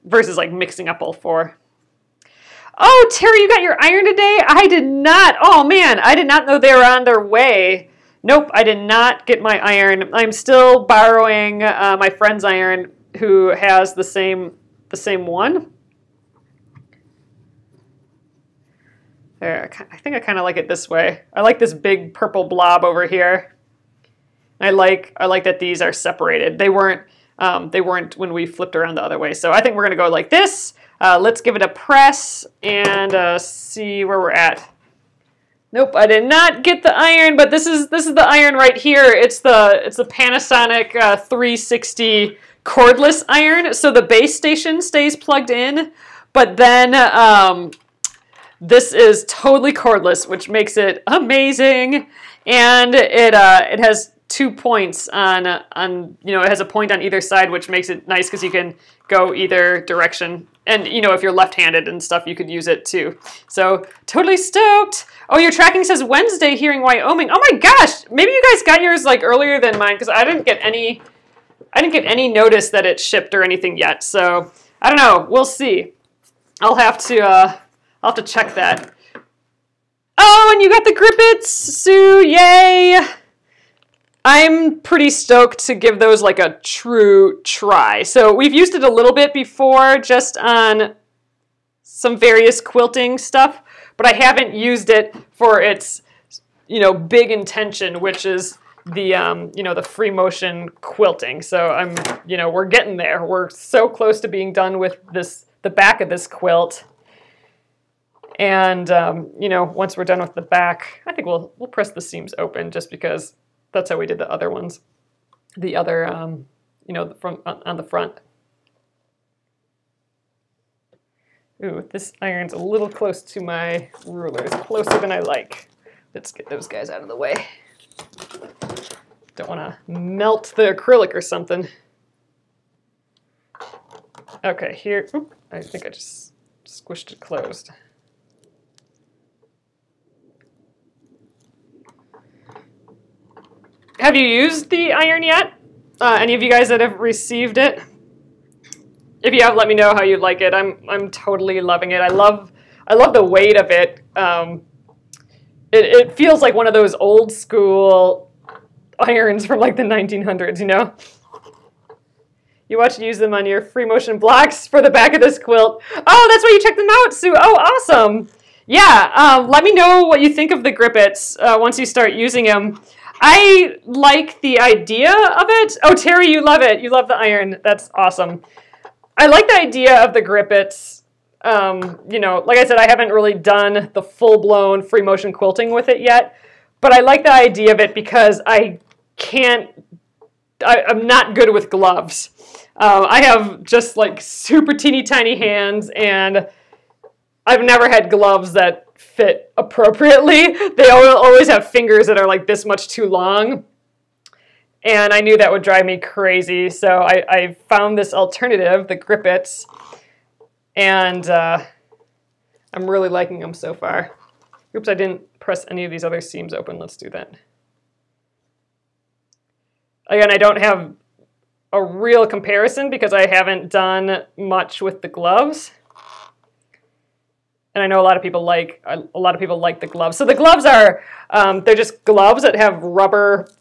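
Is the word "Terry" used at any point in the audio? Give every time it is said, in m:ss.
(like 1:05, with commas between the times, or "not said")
0:03, 2:55.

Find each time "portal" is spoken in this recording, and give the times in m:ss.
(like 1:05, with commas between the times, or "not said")
not said.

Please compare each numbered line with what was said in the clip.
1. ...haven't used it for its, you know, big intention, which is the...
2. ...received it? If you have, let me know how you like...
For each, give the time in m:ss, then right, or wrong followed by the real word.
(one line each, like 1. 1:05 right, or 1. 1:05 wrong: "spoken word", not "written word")
1. 1:34 right
2. 2:26 right.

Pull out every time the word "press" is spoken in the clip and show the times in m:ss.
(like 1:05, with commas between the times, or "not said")
0:31, 1:51, 3:35.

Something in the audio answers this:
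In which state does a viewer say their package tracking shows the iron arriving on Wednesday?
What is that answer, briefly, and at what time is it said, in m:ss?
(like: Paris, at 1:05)
Wyoming, at 1:06.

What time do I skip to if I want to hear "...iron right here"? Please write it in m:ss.
0:38.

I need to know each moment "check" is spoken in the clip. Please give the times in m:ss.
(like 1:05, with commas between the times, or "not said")
1:18, 2:46.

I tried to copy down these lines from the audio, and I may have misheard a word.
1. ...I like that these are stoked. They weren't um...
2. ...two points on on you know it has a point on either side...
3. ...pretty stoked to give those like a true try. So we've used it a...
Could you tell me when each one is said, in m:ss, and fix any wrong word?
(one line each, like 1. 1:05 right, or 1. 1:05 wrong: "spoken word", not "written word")
1. 0:25 wrong: "separated", not "stoked"
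2. 0:54 right
3. 1:24 right.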